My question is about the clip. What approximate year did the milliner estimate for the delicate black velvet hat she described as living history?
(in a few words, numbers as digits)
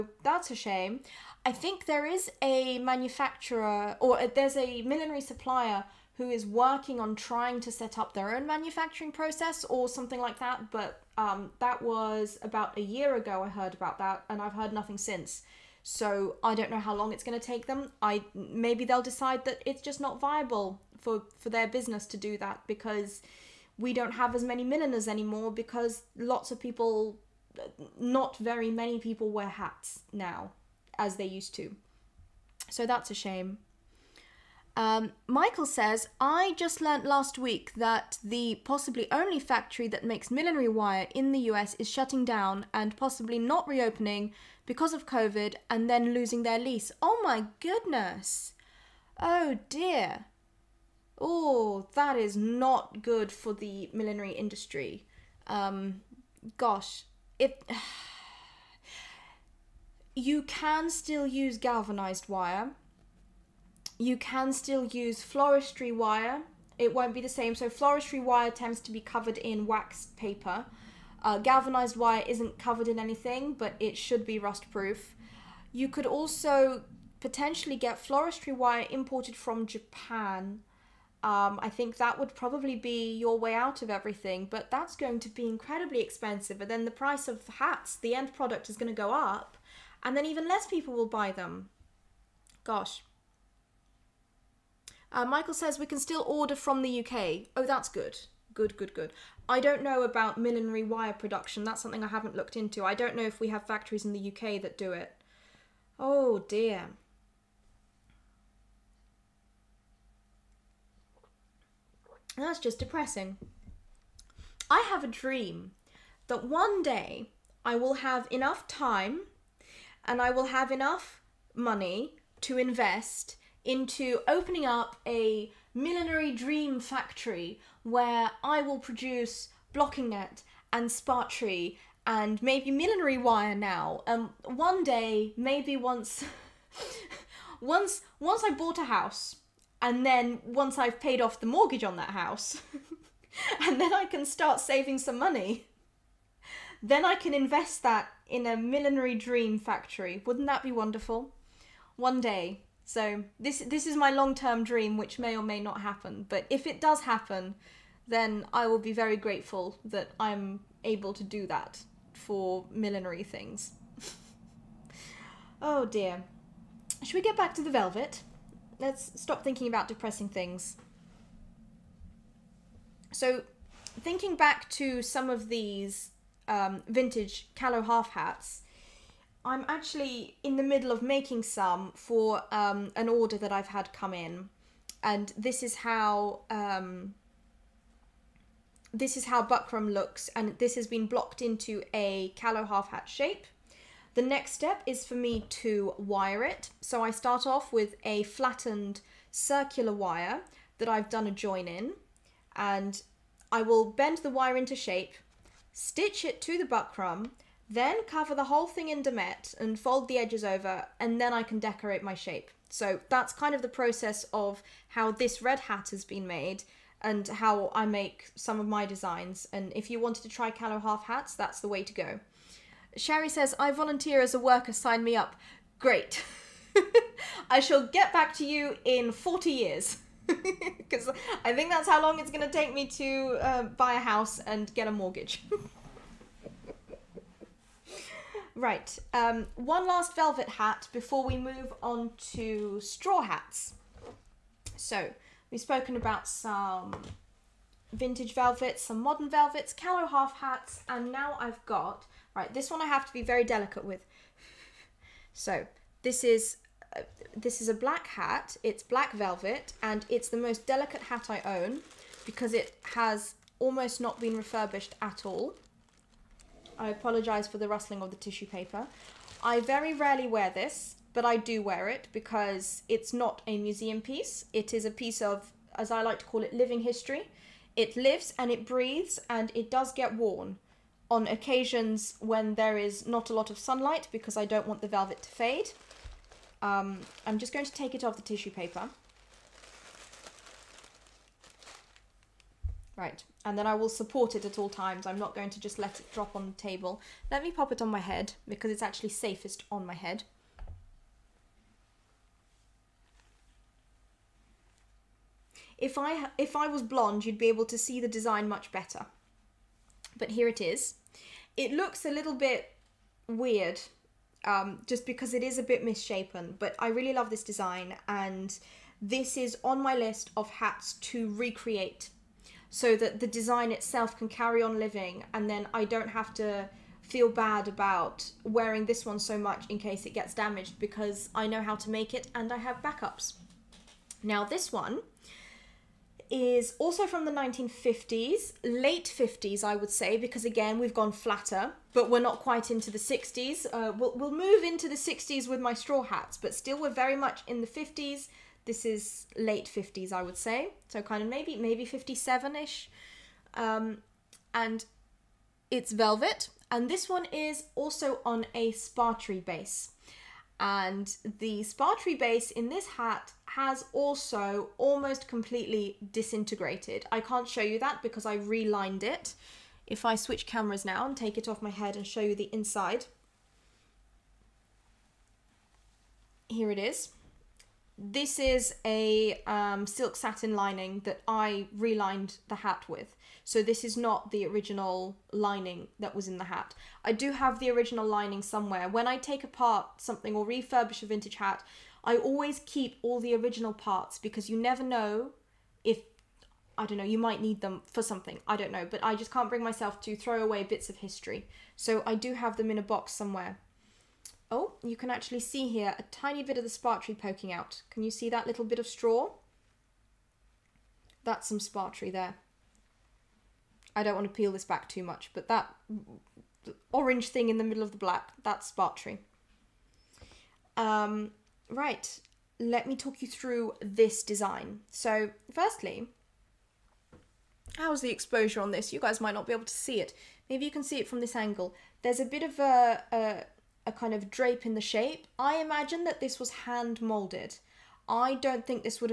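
1957.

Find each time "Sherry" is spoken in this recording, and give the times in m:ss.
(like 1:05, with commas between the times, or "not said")
3:42.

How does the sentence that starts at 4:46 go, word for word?
Um, I'm just going to take it off the tissue paper.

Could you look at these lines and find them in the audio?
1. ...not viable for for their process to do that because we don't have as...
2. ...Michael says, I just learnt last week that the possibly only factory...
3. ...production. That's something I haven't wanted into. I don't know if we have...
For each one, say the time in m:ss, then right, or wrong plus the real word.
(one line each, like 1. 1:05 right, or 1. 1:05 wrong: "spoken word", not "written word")
1. 0:20 wrong: "business", not "process"
2. 0:35 right
3. 1:41 wrong: "looked", not "wanted".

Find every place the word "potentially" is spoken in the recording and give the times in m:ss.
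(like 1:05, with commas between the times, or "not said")
1:17.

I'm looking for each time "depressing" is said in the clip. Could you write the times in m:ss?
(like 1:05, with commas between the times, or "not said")
1:52, 2:49.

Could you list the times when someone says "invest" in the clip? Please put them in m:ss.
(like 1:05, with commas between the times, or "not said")
2:02, 2:27.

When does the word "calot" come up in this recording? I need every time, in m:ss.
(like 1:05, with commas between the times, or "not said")
2:57, 3:12, 3:40, 4:09.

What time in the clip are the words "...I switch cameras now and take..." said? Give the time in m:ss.
6:10.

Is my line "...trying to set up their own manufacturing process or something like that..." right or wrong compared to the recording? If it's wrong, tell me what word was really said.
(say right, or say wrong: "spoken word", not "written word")
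right.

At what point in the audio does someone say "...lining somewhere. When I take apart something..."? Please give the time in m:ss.
6:28.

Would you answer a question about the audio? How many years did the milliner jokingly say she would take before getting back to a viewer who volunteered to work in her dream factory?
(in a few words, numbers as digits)
40.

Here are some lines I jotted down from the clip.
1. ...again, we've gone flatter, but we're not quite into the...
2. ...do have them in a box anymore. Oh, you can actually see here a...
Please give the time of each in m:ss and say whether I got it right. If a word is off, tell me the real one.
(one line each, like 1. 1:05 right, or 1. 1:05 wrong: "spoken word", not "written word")
1. 5:40 right
2. 6:42 wrong: "somewhere", not "anymore".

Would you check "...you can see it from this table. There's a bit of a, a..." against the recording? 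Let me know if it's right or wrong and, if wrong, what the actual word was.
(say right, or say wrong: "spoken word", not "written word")
wrong: "angle", not "table".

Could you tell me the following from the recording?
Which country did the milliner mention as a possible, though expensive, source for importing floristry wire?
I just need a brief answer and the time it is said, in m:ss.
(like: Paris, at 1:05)
Japan, at 1:19.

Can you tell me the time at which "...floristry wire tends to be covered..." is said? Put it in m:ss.
1:07.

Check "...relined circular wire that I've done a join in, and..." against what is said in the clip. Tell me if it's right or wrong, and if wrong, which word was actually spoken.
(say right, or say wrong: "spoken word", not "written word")
wrong: "flattened", not "relined".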